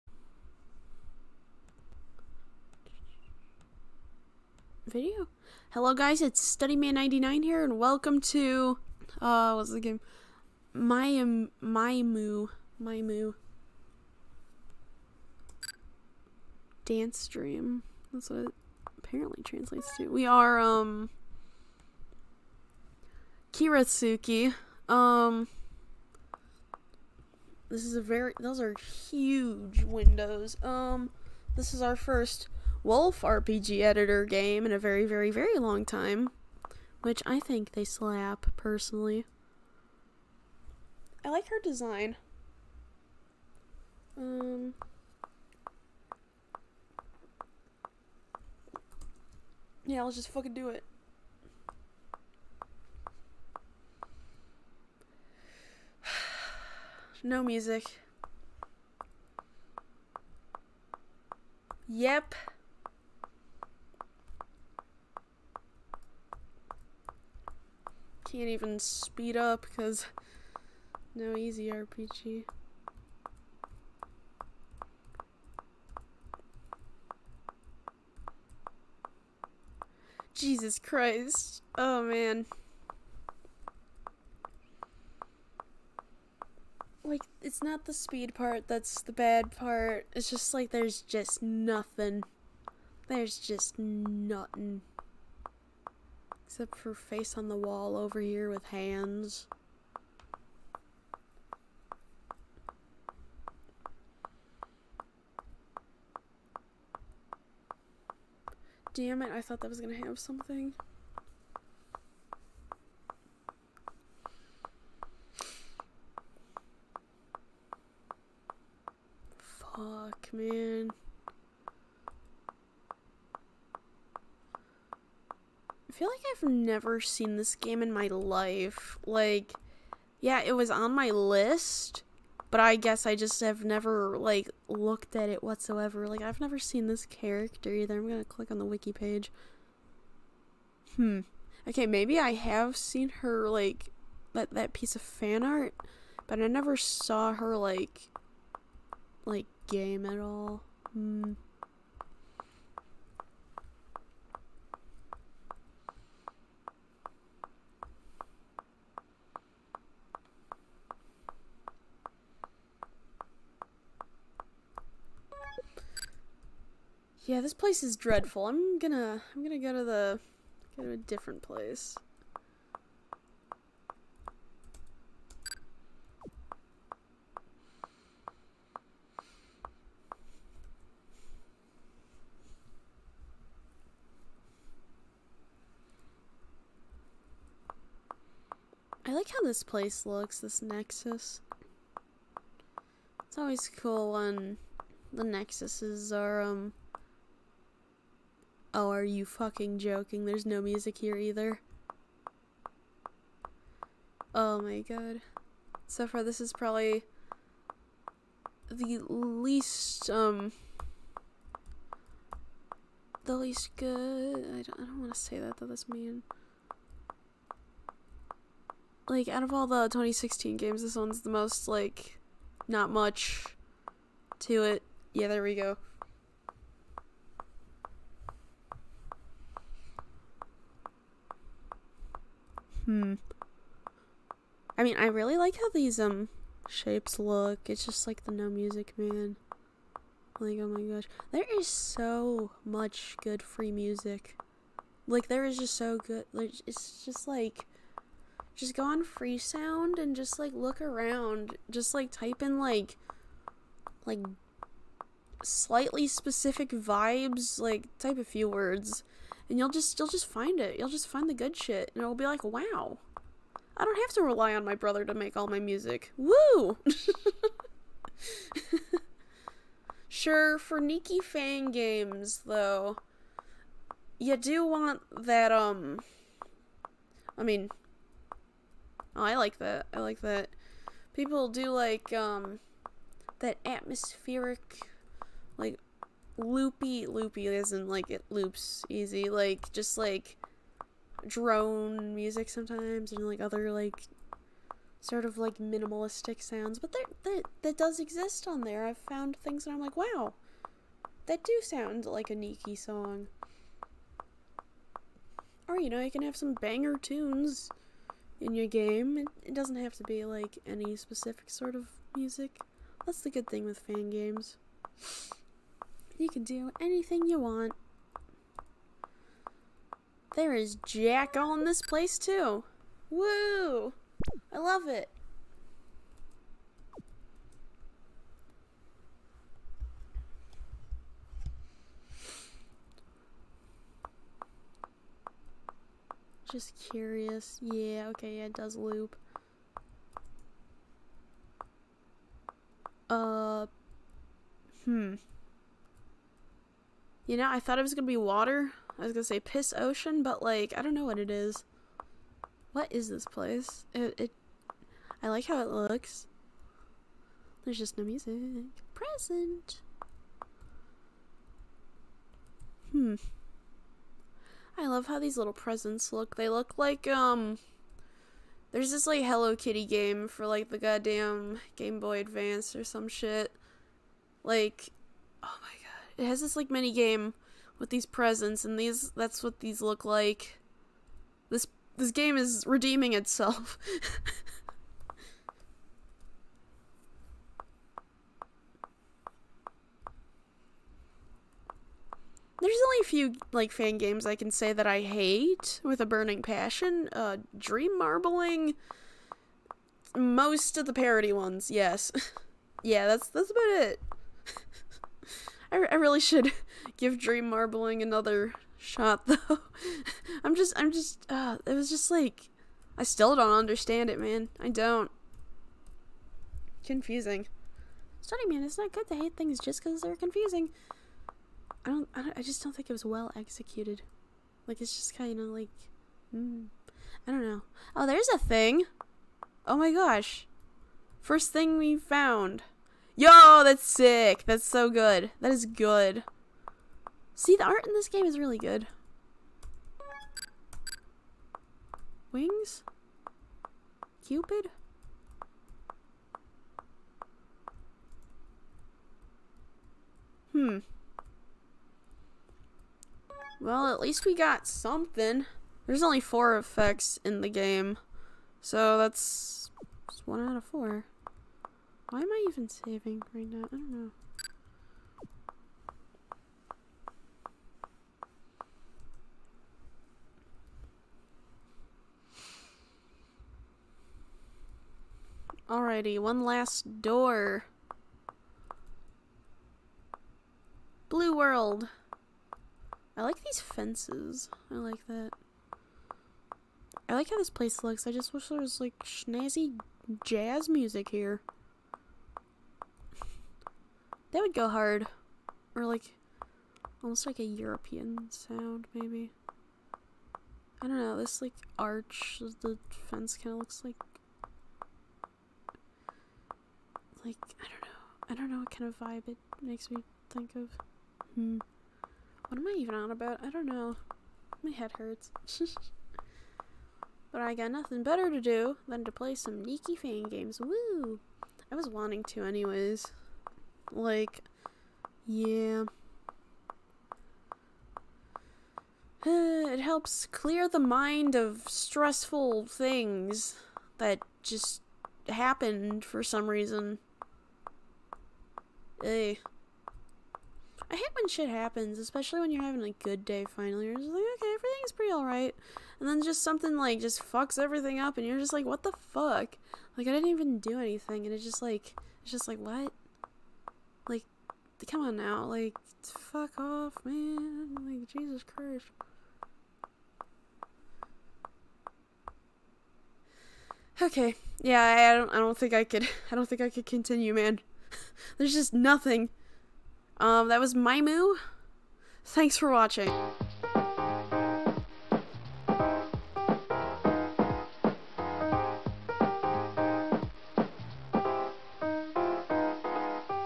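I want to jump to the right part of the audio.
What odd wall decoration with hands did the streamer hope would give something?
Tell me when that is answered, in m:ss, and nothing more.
1:36.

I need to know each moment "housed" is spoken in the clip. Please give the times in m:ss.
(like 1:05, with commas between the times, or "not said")
not said.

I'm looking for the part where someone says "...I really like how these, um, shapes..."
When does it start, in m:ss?
3:54.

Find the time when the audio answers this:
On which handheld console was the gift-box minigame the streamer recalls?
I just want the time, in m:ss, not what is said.
6:11.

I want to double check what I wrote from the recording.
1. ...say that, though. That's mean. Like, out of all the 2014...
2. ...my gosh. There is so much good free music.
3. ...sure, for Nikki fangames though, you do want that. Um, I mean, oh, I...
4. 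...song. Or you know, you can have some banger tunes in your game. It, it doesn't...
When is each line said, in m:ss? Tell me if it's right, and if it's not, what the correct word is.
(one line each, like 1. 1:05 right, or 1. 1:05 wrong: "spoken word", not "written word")
1. 3:35 wrong: "2016", not "2014"
2. 4:00 right
3. 4:30 right
4. 5:02 right.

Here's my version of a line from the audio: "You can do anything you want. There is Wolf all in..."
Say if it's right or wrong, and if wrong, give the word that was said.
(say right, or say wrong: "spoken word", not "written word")
wrong: "Jack", not "Wolf".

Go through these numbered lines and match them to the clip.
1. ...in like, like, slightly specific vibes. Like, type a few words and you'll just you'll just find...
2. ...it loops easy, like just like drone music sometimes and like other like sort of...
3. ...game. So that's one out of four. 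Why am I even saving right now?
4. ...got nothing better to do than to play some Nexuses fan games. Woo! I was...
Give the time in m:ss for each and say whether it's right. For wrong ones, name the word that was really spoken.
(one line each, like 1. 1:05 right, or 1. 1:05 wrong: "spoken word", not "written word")
1. 4:12 right
2. 4:48 right
3. 7:37 right
4. 8:37 wrong: "Nikki", not "Nexuses".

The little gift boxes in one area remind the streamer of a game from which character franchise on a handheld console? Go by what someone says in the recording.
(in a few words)
Hello Kitty.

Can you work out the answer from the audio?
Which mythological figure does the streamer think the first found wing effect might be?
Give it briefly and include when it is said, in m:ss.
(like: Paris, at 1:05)
Cupid, at 7:24.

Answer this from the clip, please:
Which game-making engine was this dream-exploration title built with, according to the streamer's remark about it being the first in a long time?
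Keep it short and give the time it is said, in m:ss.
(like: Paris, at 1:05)
Wolf RPG Editor, at 0:32.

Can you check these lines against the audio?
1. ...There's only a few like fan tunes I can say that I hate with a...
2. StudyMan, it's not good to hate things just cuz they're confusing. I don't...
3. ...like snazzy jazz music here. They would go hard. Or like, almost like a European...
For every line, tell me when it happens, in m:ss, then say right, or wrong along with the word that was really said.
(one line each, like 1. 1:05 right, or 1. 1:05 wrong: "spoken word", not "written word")
1. 6:32 wrong: "games", not "tunes"
2. 6:58 right
3. 8:08 right.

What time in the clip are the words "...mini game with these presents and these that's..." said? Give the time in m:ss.
6:16.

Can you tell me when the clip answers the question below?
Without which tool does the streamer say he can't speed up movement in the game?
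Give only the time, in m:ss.
1:11.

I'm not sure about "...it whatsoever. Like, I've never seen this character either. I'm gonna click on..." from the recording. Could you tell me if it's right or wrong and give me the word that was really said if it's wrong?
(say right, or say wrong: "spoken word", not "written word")
right.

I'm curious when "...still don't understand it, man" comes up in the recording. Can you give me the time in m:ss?
6:53.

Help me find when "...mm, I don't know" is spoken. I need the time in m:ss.
7:06.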